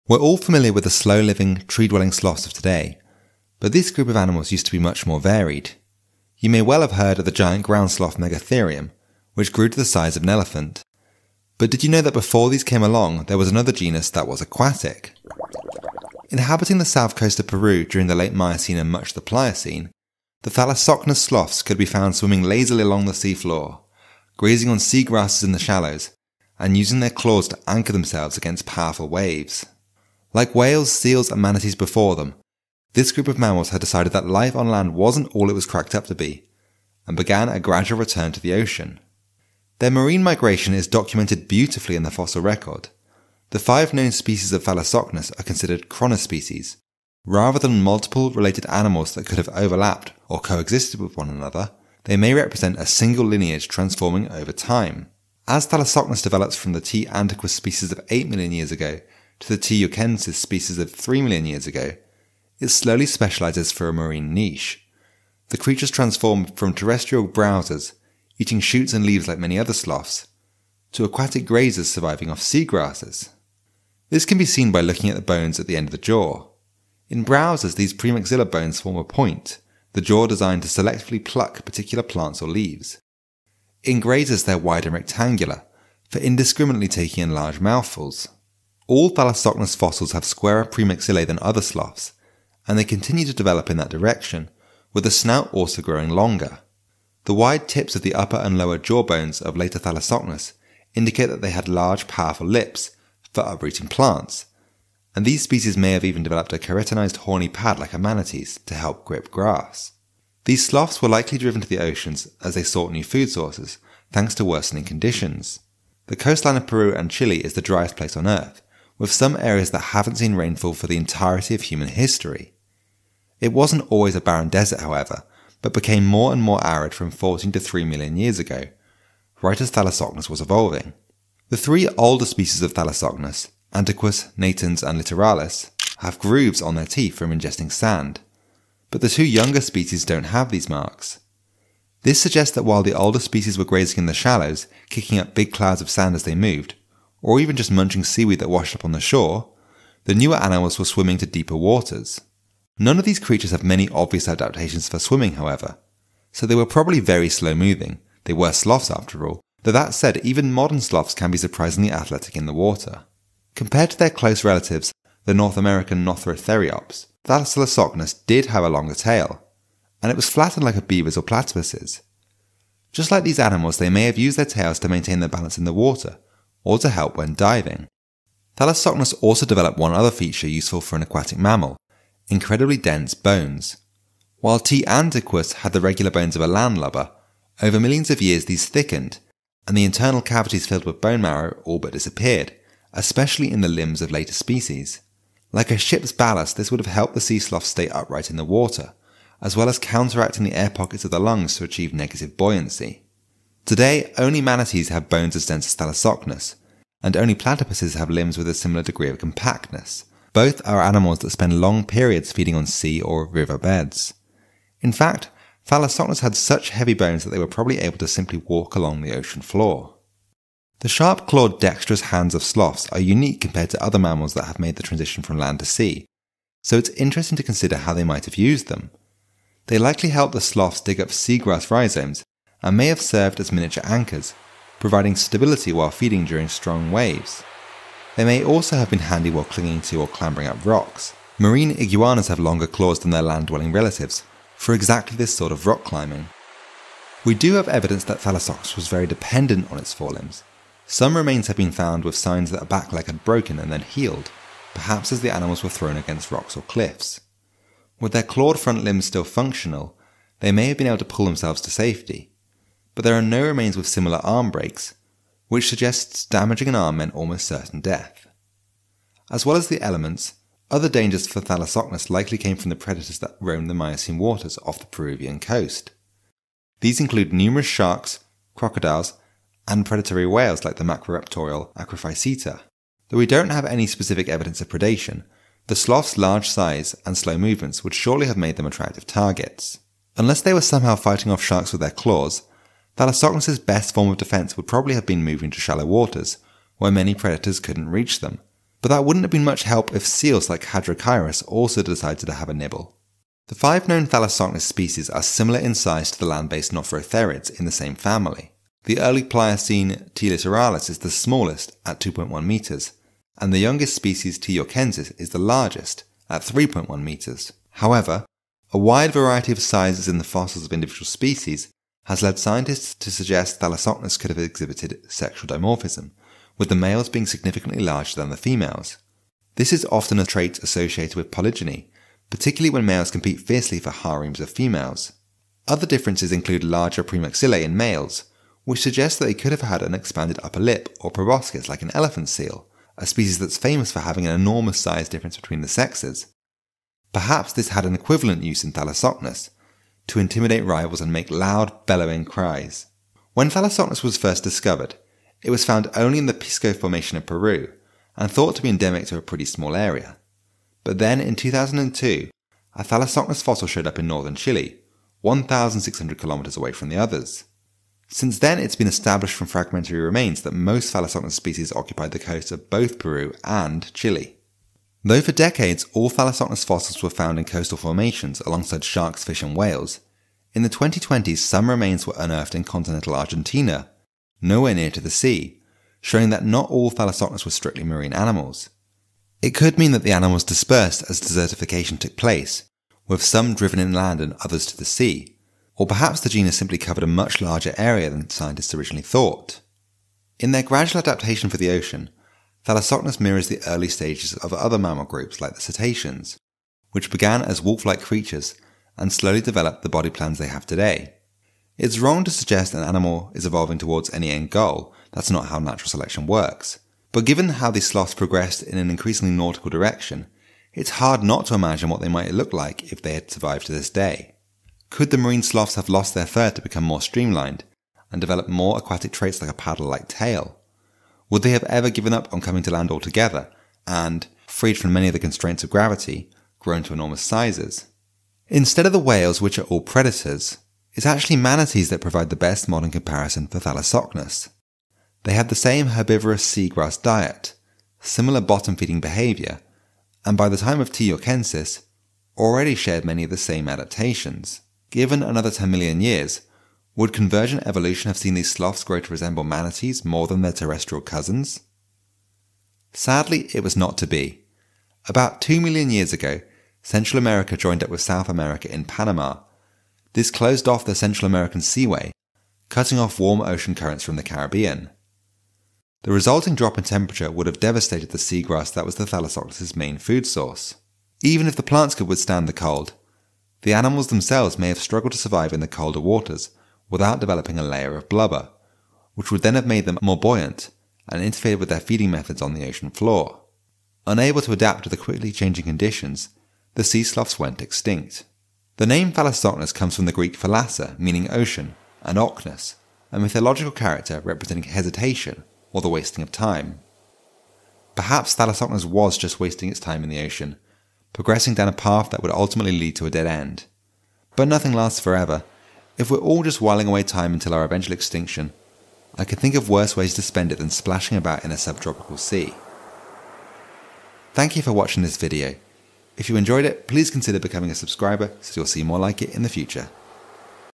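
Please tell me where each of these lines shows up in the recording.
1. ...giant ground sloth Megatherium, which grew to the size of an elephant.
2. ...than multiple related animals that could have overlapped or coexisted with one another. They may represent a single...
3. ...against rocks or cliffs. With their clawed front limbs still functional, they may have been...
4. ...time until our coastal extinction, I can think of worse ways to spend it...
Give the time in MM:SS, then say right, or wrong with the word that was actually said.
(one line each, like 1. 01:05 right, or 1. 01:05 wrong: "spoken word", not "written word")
1. 00:07 right
2. 00:47 right
3. 04:15 right
4. 08:37 wrong: "eventual", not "coastal".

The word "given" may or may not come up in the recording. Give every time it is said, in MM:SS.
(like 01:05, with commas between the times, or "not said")
06:57, 07:11, 07:34.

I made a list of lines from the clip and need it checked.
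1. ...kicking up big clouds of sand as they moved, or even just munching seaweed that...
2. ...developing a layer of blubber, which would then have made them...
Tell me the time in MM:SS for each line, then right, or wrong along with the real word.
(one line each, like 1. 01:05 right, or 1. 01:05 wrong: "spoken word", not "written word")
1. 02:24 right
2. 08:07 right.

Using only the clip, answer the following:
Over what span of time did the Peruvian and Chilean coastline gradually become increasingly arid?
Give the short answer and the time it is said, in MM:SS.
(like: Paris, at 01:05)
14 to 3 million years ago, at 02:07.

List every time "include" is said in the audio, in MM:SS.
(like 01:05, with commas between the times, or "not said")
04:36, 05:36.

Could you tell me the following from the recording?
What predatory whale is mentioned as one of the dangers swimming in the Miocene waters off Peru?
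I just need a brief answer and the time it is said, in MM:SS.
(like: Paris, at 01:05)
Acrophyseter, at 04:41.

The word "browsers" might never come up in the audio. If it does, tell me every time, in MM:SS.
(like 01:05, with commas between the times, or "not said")
01:07, 01:17.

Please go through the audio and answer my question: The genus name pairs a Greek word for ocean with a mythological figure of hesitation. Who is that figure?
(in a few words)
Ochnus.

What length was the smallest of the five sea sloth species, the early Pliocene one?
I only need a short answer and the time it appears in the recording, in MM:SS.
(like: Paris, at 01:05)
2.1 meters, at 05:11.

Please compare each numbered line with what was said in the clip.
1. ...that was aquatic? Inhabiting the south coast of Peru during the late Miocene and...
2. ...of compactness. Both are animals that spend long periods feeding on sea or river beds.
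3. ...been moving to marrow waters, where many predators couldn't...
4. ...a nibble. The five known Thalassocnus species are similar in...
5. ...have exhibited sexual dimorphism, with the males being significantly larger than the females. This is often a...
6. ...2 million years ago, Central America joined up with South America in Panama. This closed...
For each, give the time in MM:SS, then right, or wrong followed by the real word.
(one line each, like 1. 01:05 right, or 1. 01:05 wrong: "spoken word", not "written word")
1. 00:14 right
2. 03:29 right
3. 04:55 wrong: "shallow", not "marrow"
4. 05:02 right
5. 05:24 right
6. 07:45 right.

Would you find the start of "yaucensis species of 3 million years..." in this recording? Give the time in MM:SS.
00:59.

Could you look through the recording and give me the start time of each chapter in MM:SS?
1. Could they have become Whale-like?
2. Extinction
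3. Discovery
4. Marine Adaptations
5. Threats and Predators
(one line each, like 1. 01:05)
1. 06:39
2. 07:42
3. 05:52
4. 00:45
5. 03:40.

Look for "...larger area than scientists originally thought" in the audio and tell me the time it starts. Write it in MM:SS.
06:37.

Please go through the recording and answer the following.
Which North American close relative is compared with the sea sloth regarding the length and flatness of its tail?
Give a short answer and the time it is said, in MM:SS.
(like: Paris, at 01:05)
Nothrotheriops, at 02:46.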